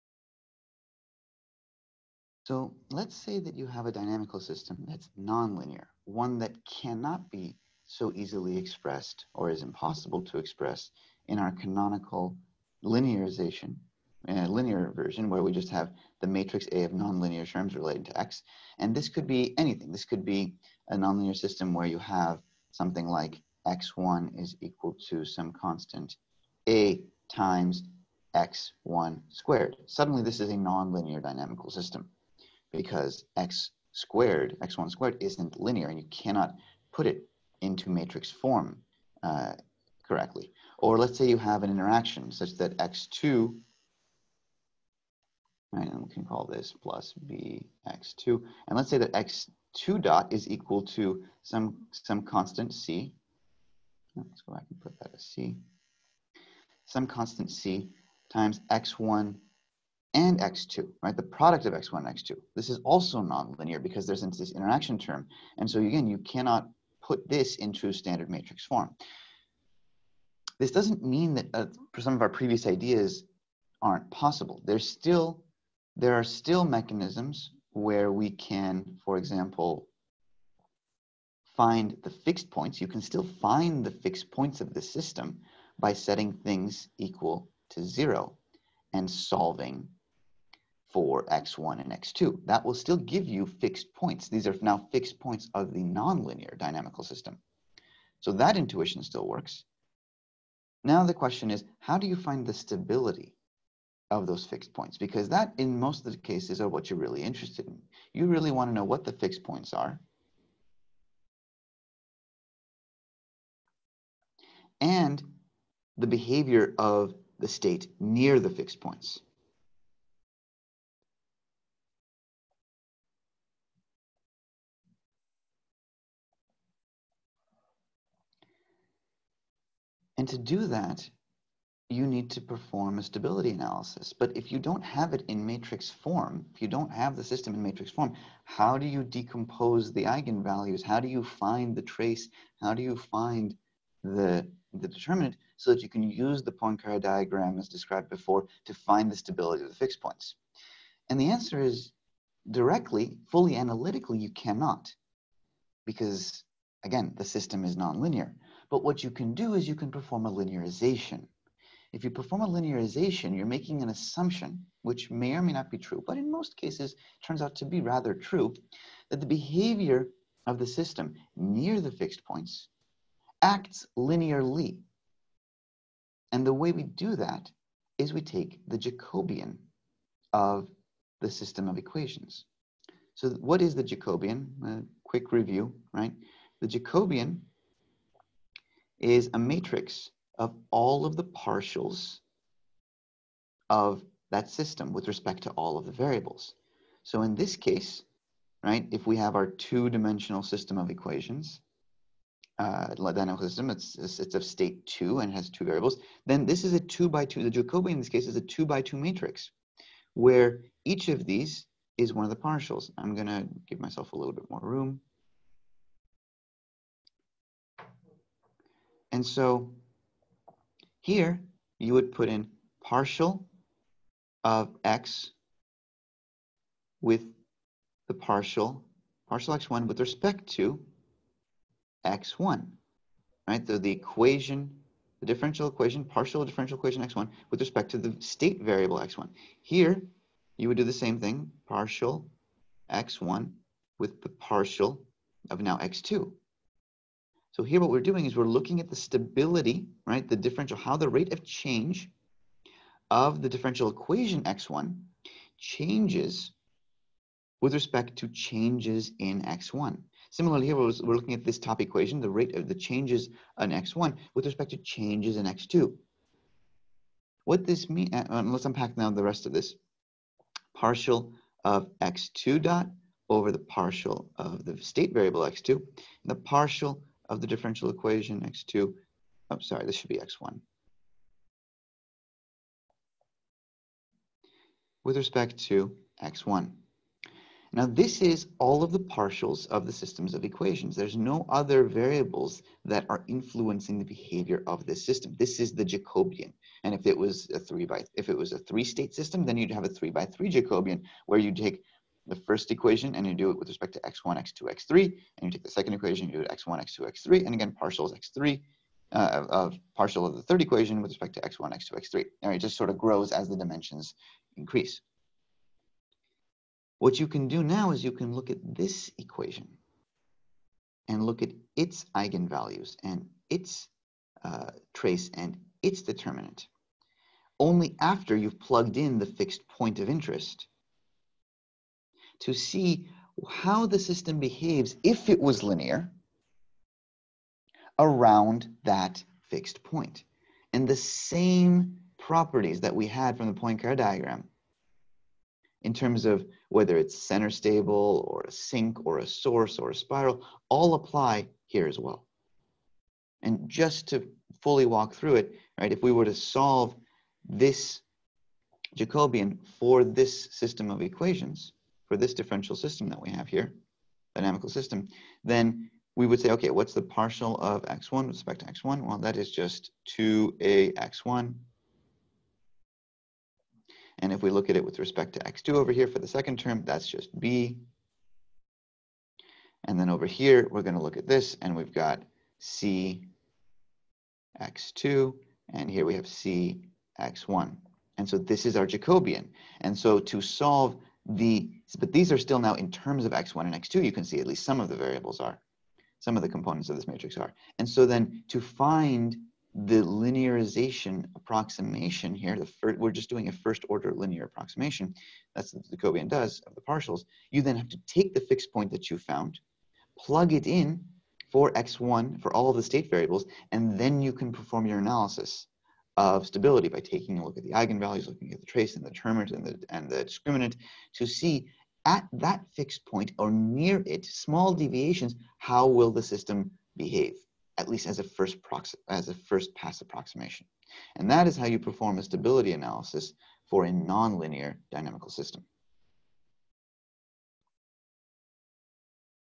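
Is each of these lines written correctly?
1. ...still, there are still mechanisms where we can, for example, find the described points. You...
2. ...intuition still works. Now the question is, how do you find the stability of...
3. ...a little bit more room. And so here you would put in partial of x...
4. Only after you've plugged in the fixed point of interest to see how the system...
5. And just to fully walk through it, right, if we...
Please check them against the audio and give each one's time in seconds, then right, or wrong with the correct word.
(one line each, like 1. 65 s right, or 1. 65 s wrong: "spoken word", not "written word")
1. 74 s wrong: "fixed", not "described"
2. 98 s right
3. 214 s right
4. 327 s right
5. 353 s right.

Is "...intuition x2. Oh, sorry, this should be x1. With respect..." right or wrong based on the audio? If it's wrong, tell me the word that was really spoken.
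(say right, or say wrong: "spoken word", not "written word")
wrong: "equation", not "intuition".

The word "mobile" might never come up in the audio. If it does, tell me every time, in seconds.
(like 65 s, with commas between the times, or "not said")
not said.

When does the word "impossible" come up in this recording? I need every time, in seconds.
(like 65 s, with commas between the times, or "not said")
9 s.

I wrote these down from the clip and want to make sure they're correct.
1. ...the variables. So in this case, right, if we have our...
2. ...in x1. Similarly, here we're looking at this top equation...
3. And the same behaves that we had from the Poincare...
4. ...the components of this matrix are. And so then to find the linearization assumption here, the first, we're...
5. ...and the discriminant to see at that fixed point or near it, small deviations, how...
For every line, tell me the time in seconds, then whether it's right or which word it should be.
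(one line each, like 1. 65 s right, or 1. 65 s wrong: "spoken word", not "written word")
1. 195 s right
2. 259 s right
3. 340 s wrong: "properties", not "behaves"
4. 396 s wrong: "approximation", not "assumption"
5. 419 s right.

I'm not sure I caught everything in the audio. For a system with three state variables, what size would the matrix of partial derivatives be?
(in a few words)
3 by 3.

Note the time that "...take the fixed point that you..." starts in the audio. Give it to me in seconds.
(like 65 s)
408 s.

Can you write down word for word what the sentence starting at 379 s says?
And then over here, we're going to look at this, and we've got c x2, and here we have c x1.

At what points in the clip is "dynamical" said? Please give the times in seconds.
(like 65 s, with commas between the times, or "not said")
3 s, 31 s, 96 s, 202 s, 364 s, 434 s.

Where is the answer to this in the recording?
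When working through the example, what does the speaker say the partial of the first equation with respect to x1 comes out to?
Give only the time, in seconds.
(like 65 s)
370 s.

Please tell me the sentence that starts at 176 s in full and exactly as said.
And the way we do that is we take the Jacobian of the system of equations.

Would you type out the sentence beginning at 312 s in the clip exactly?
And it just sort of grows as the dimensions increase.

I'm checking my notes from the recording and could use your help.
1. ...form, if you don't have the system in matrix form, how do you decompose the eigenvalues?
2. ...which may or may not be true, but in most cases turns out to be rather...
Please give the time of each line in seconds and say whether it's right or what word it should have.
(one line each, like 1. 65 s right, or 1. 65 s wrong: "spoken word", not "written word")
1. 135 s right
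2. 164 s right.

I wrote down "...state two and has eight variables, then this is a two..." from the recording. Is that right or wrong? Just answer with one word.
wrong.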